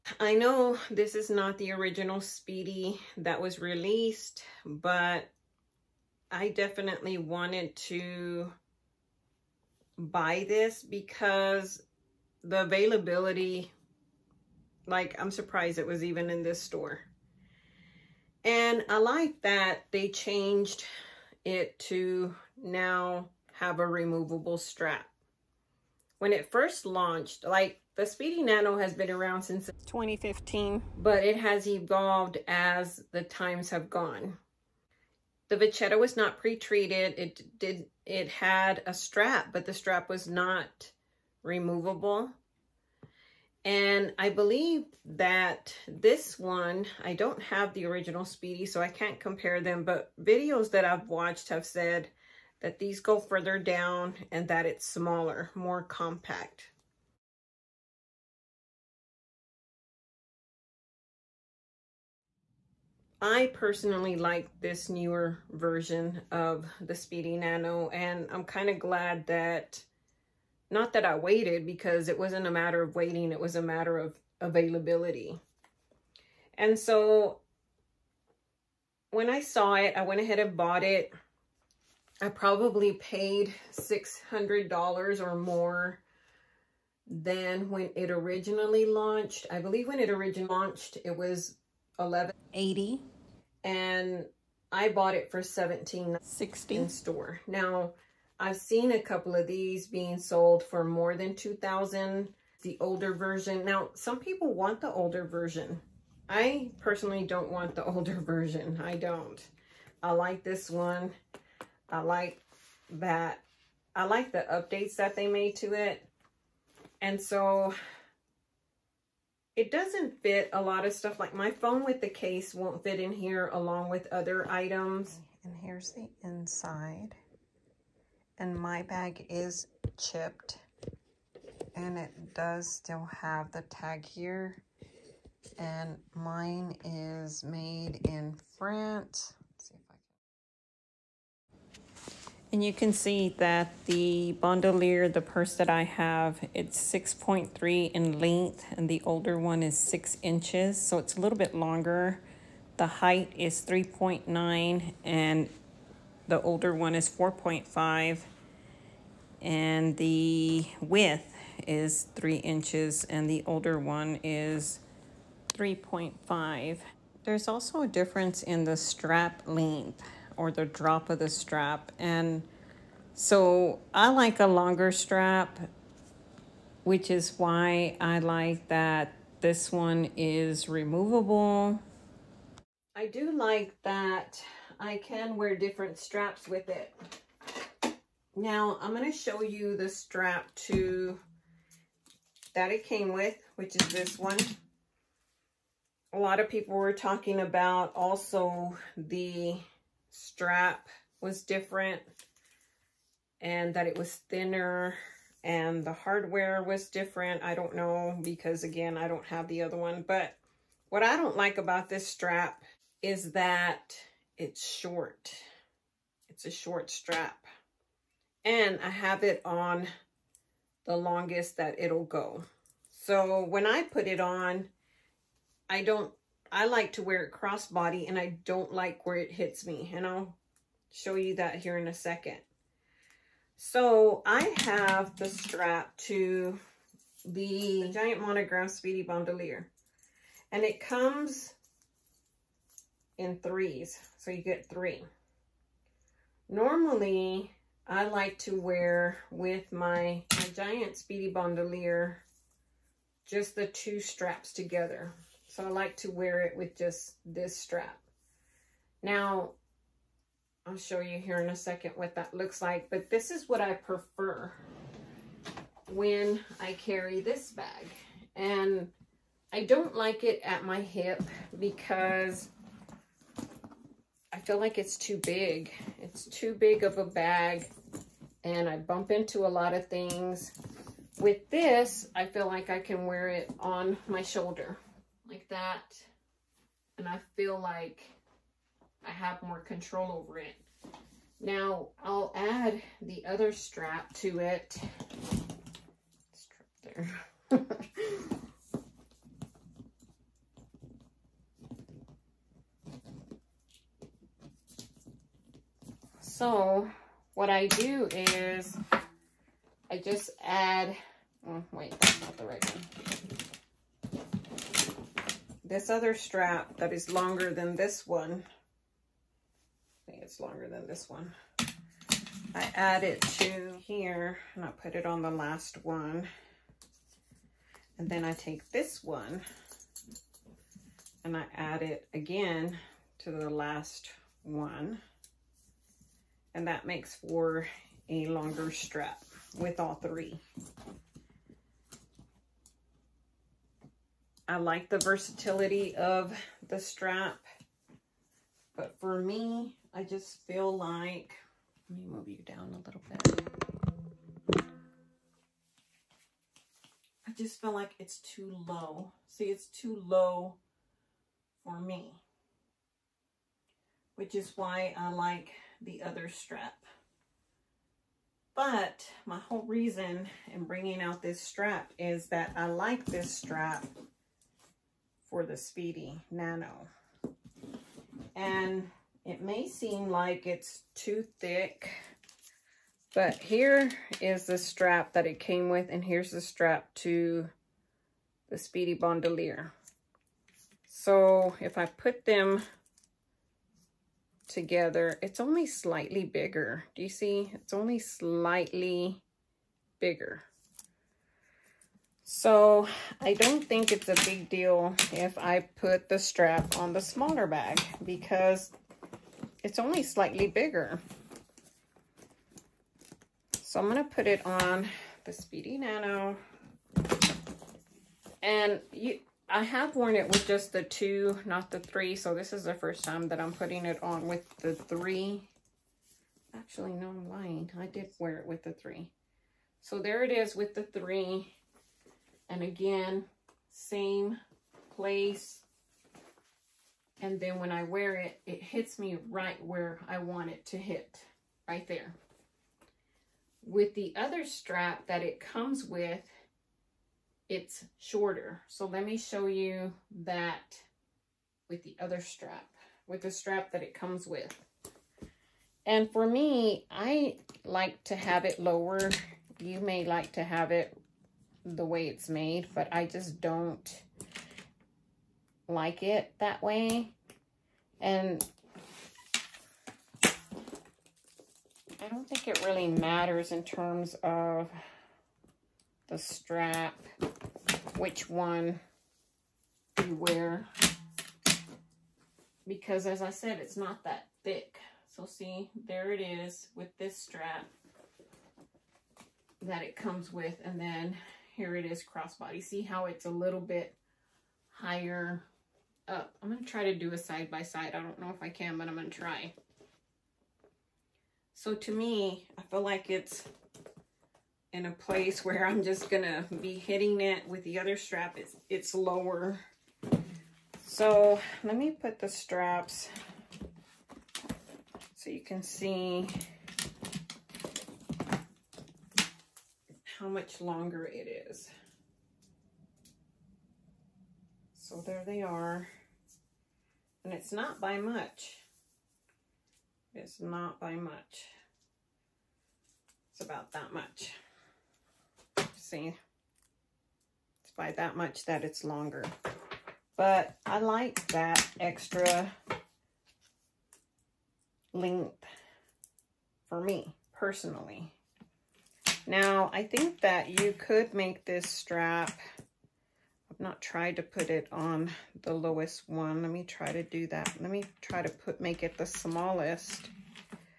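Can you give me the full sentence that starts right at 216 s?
It's a short strap and I have it on the longest that it'll go.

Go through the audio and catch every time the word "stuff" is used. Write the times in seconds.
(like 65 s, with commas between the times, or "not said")
120 s.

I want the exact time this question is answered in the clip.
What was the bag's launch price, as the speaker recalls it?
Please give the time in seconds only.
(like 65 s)
91 s.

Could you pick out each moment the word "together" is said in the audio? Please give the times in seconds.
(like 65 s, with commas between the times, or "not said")
254 s, 394 s.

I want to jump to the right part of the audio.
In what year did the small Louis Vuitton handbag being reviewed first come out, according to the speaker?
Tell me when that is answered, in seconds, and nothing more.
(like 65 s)
29 s.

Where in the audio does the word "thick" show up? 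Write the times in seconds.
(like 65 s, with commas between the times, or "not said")
381 s, 484 s.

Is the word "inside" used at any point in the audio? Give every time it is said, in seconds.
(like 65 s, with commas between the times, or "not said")
126 s.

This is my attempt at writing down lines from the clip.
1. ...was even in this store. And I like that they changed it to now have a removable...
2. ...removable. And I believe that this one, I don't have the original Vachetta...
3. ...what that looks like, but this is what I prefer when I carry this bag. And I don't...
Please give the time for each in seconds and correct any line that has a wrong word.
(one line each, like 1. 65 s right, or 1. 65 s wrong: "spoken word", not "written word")
1. 15 s right
2. 41 s wrong: "Speedy", not "Vachetta"
3. 261 s right.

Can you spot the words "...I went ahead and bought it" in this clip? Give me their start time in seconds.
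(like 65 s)
79 s.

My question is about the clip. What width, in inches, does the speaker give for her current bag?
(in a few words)
3 inches.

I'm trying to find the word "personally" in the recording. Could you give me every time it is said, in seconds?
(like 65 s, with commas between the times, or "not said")
63 s, 106 s, 547 s.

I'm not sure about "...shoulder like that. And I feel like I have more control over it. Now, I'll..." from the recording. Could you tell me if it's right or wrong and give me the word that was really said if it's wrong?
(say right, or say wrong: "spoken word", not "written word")
right.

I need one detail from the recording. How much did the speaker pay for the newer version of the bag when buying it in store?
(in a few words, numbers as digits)
1760.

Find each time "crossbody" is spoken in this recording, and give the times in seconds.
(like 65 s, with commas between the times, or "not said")
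227 s, 492 s.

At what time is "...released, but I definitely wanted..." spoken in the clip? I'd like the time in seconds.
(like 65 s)
3 s.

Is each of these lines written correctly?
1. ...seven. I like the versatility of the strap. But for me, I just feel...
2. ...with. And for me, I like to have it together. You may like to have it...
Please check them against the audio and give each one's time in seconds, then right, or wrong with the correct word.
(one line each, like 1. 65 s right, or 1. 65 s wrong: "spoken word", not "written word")
1. 339 s wrong: "three", not "seven"
2. 454 s wrong: "lower", not "together".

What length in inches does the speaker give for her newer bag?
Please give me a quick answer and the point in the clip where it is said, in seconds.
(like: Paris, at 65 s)
6.3, at 146 s.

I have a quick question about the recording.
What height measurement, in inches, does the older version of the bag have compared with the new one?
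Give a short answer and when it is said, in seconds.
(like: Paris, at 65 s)
4.5, at 157 s.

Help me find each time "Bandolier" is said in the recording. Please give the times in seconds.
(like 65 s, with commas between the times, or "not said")
144 s, 239 s, 251 s, 388 s.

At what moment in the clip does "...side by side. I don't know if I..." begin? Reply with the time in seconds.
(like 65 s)
497 s.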